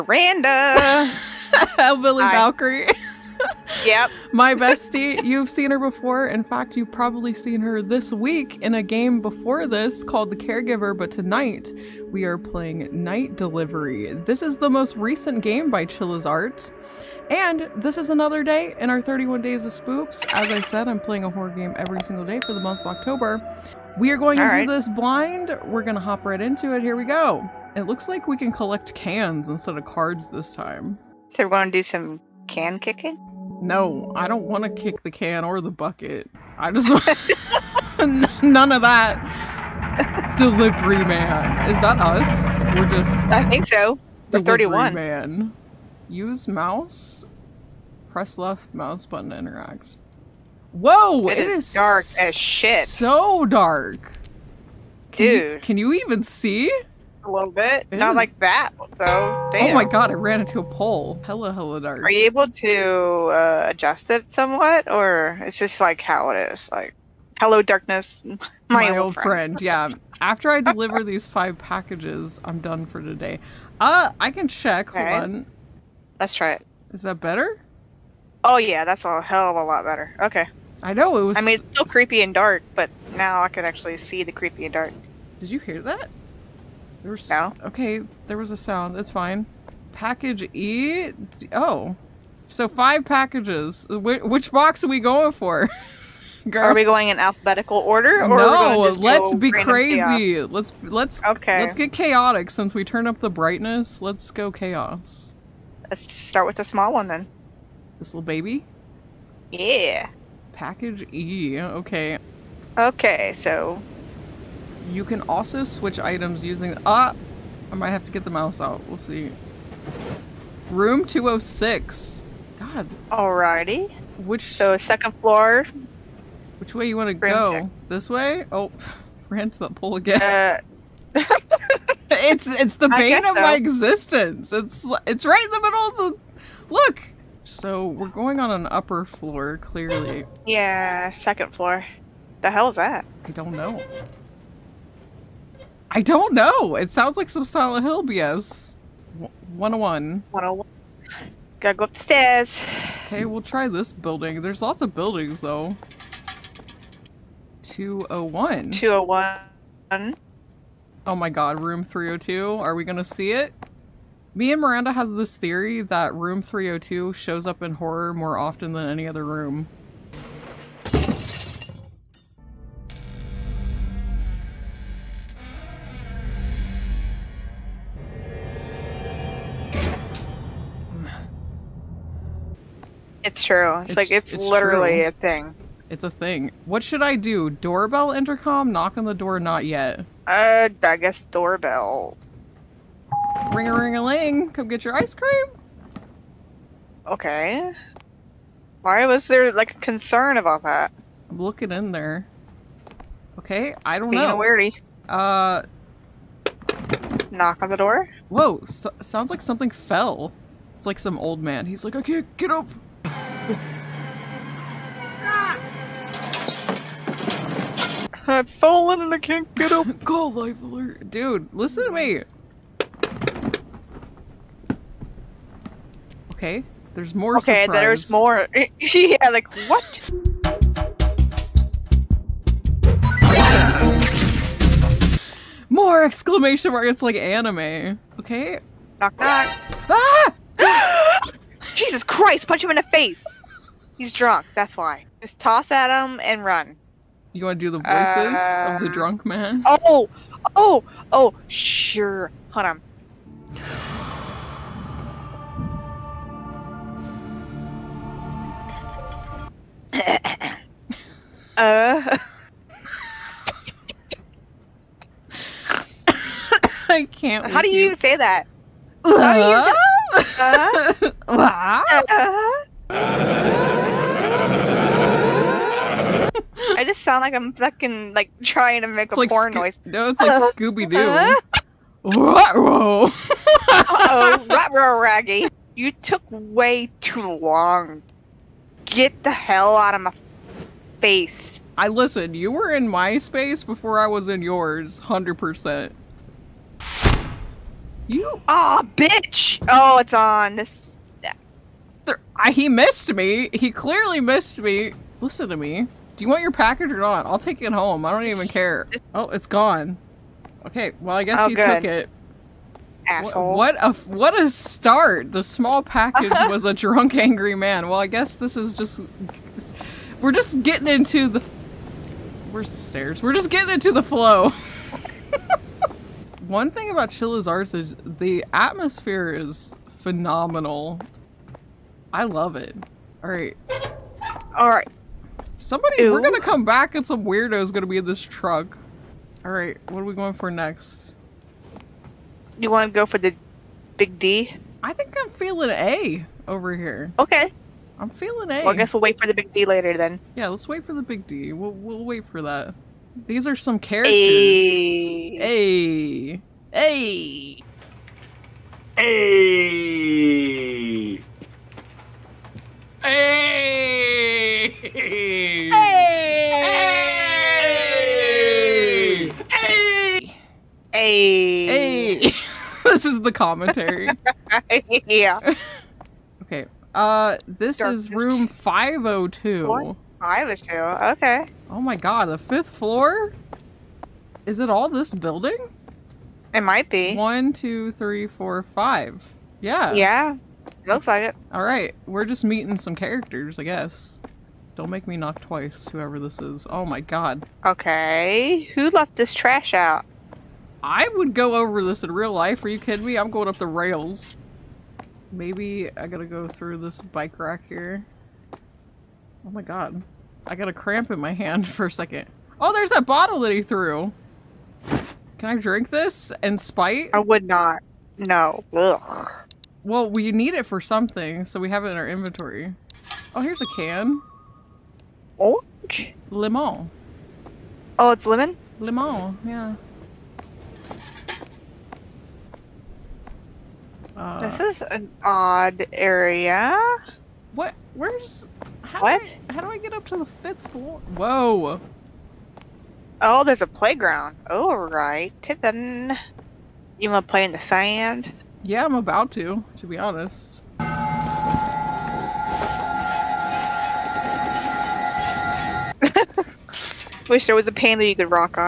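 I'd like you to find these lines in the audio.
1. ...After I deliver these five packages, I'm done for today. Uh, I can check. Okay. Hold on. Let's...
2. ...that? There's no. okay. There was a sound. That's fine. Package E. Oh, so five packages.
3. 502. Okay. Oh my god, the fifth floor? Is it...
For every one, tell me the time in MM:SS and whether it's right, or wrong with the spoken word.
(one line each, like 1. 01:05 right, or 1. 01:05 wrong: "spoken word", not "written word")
1. 01:10 right
2. 01:25 right
3. 06:20 right.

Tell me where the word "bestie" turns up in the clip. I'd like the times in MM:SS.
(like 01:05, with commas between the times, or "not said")
00:04.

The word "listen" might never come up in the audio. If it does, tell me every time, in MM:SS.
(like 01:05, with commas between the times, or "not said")
03:41, 04:51, 05:05.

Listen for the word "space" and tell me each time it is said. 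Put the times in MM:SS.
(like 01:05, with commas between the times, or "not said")
04:53.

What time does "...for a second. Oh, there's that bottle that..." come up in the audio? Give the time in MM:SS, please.
06:51.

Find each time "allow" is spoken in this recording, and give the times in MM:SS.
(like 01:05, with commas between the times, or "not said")
not said.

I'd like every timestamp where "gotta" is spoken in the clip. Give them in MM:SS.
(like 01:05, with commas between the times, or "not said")
02:31, 06:46.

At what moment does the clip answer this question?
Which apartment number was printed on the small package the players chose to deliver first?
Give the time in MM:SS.
02:00.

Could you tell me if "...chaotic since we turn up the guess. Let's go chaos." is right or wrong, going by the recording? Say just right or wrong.
wrong.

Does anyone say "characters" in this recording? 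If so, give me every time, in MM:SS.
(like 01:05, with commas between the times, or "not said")
05:53, 06:32.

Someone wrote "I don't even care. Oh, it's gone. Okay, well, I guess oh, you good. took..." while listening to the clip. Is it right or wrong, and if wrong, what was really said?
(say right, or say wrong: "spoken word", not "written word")
right.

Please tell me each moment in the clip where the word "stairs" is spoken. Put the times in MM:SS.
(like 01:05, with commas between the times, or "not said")
02:32, 05:22.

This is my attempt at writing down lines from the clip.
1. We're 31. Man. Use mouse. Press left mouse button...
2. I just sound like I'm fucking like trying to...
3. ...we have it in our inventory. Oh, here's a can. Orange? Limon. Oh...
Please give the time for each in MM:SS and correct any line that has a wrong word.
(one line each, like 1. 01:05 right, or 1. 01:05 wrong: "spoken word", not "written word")
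1. 00:44 right
2. 04:36 right
3. 07:01 right.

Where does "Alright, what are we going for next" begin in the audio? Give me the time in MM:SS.
05:39.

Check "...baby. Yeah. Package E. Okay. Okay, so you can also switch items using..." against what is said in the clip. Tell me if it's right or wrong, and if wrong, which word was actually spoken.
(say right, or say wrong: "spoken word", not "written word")
right.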